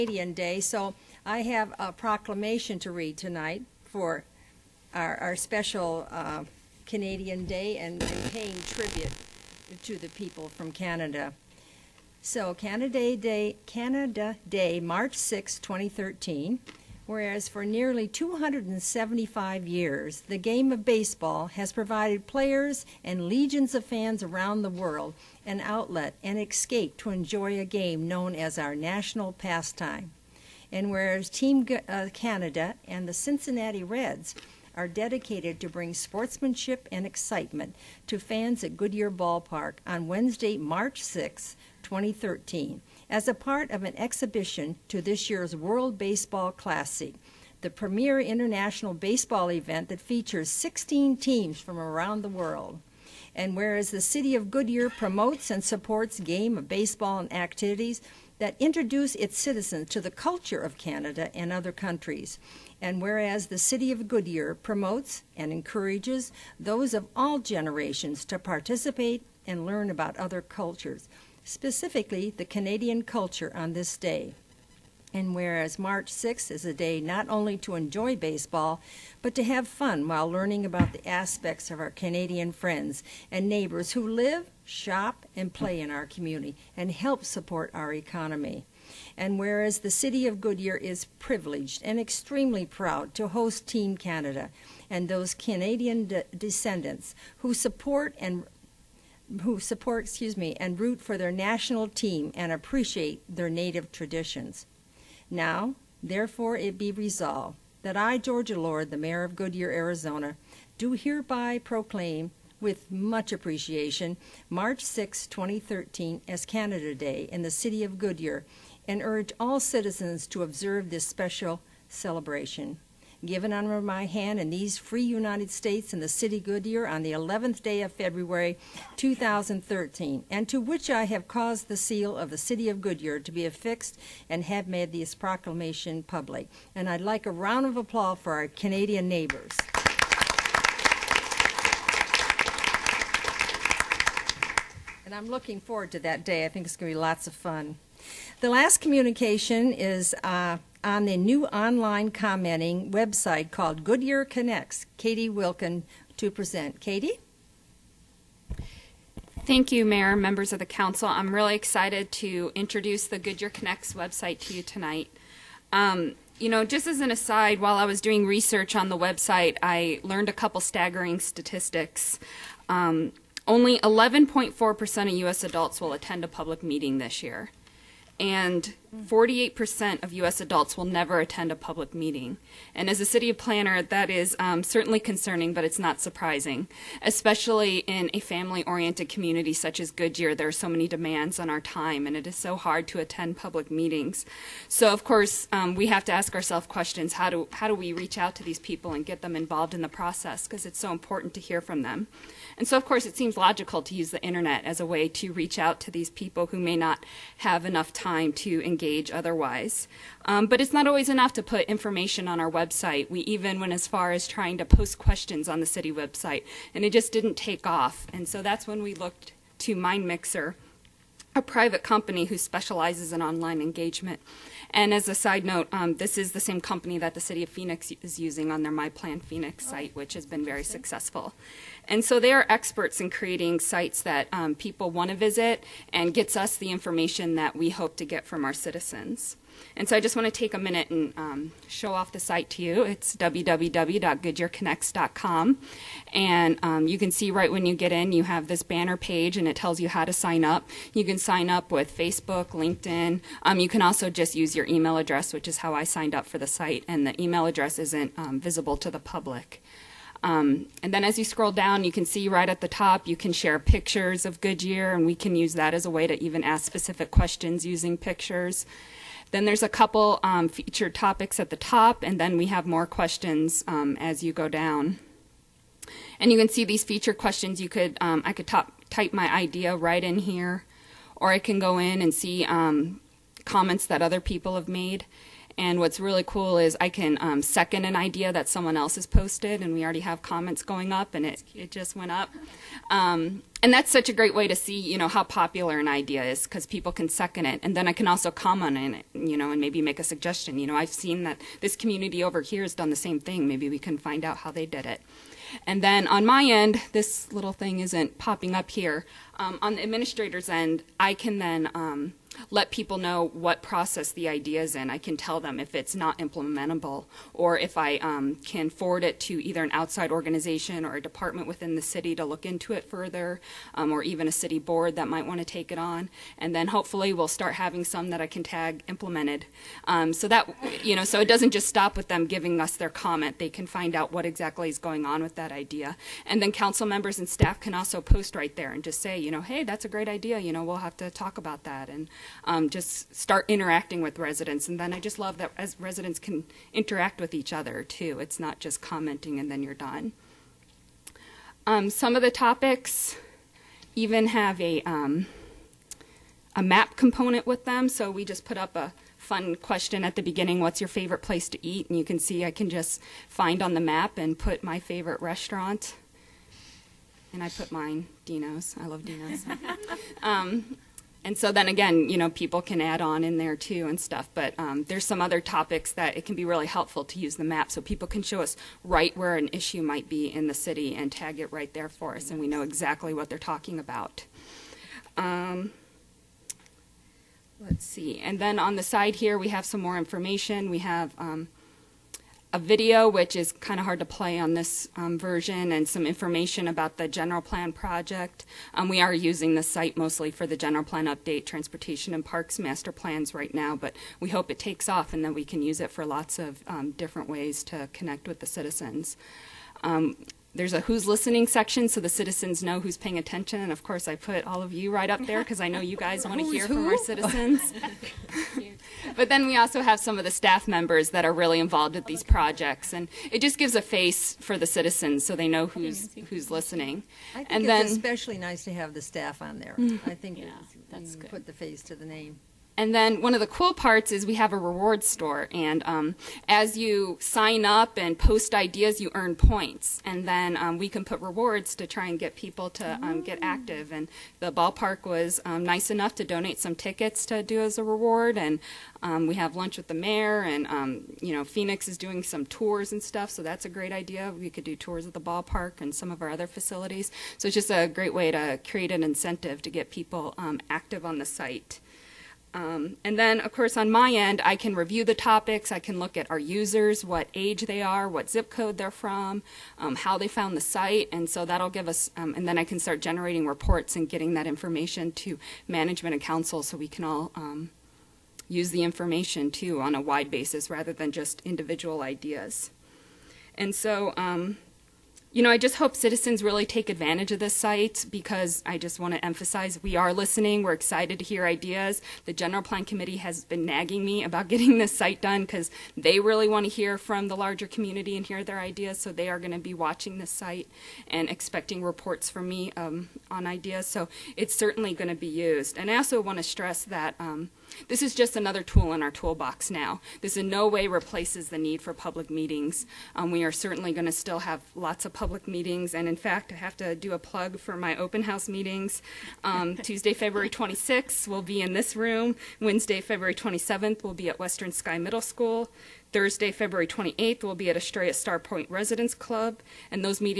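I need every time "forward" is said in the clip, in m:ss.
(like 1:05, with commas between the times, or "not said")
2:25, 5:18.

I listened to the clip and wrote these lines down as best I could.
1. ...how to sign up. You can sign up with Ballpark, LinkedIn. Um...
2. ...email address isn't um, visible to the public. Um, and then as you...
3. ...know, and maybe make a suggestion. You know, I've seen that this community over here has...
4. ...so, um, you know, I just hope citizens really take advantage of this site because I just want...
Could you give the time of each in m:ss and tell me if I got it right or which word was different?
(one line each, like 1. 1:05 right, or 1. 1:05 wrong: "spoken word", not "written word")
1. 4:09 wrong: "Facebook", not "Ballpark"
2. 4:17 right
3. 4:59 right
4. 8:03 right.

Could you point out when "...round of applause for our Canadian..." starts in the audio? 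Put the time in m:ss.
2:17.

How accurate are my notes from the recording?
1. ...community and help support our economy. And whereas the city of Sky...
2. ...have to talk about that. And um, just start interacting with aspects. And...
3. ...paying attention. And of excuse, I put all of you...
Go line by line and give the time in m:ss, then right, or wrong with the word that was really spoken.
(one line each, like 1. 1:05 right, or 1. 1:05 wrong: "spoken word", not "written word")
1. 1:26 wrong: "Goodyear", not "Sky"
2. 5:40 wrong: "residents", not "aspects"
3. 6:52 wrong: "course", not "excuse".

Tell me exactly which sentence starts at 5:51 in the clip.
Um, some of the topics even have a um, a map component with them.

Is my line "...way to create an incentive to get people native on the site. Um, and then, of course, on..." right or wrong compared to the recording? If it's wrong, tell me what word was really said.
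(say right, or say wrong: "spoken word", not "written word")
wrong: "active", not "native".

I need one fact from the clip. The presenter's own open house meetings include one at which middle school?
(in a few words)
Western Sky Middle School.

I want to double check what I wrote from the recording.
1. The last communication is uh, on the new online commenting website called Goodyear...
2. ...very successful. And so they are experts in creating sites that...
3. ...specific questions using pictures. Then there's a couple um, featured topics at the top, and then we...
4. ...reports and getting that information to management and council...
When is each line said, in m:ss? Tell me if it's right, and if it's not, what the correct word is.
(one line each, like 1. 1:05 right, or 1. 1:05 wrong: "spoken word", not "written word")
1. 2:28 right
2. 3:50 right
3. 4:26 right
4. 7:53 right.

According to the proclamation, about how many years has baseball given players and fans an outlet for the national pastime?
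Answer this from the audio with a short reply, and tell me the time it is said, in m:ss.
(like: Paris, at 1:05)
275, at 0:18.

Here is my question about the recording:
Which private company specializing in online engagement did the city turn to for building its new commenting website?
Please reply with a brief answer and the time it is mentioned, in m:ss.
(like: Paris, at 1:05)
MindMixer, at 3:39.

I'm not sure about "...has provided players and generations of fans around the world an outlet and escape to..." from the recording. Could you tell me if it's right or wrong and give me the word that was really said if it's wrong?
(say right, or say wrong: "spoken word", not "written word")
wrong: "legions", not "generations".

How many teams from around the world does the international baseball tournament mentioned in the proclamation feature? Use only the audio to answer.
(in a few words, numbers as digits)
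16.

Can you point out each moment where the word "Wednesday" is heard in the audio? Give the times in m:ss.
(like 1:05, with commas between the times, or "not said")
0:40, 8:42.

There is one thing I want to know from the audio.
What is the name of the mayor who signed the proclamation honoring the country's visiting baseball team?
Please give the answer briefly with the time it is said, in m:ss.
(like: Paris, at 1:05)
Georgia Lord, at 1:48.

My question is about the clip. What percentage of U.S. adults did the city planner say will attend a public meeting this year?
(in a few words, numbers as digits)
11.4%.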